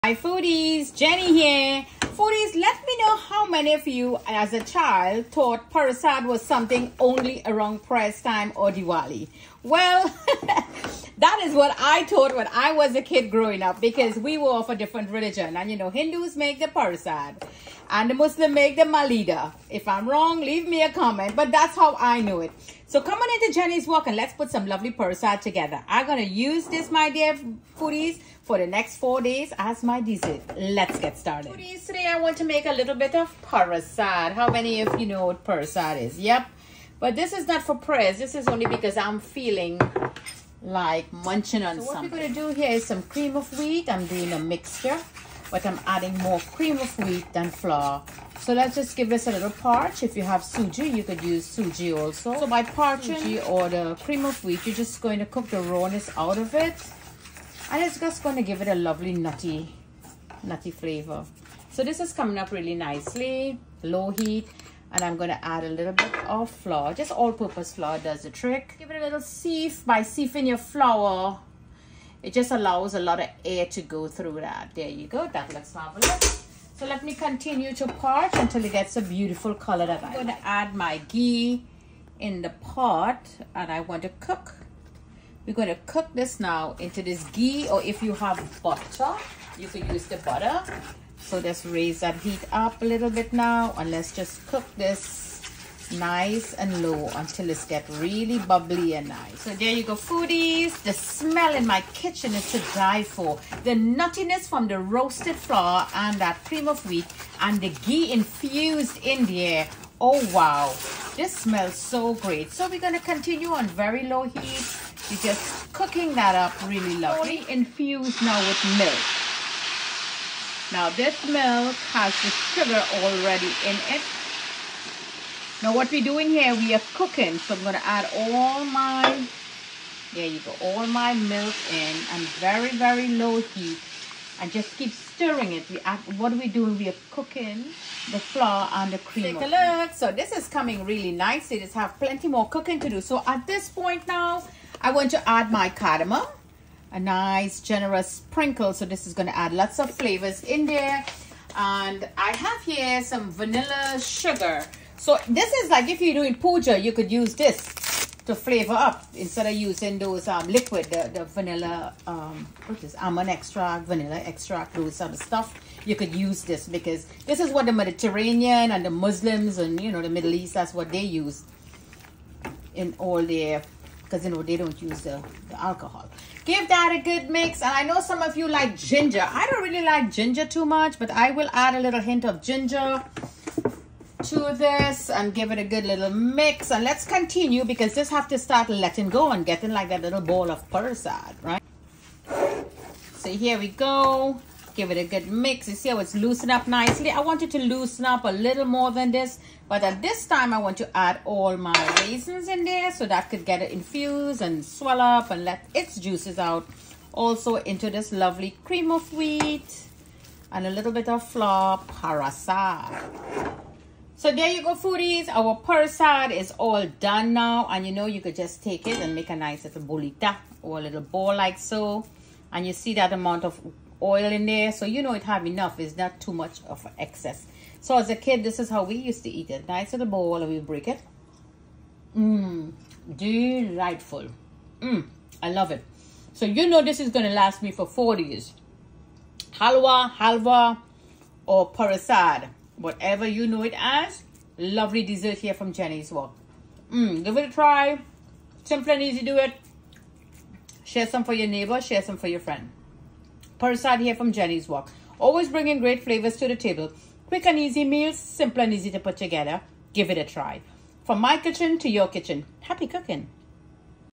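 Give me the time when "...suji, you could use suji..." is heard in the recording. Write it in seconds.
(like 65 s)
50 s.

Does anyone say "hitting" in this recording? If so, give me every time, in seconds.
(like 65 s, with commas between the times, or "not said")
not said.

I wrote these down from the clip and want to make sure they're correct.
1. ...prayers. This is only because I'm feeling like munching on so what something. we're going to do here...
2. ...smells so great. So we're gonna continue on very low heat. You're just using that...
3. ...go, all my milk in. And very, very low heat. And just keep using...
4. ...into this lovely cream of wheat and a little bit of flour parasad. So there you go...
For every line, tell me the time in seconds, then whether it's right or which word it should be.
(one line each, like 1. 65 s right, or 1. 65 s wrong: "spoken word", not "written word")
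1. 37 s right
2. 111 s wrong: "cooking", not "using"
3. 130 s wrong: "stirring", not "using"
4. 207 s right.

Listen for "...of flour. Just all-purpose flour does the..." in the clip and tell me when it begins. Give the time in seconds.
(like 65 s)
66 s.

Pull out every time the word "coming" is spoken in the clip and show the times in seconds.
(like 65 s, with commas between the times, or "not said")
23 s, 62 s, 140 s.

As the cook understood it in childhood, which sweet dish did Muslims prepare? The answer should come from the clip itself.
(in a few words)
malida.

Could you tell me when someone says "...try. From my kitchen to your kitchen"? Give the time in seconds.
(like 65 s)
260 s.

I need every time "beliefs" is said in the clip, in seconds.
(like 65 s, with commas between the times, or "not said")
not said.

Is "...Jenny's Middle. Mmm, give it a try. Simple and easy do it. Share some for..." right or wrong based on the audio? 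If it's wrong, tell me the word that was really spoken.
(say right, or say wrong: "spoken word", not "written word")
wrong: "Wok", not "Middle".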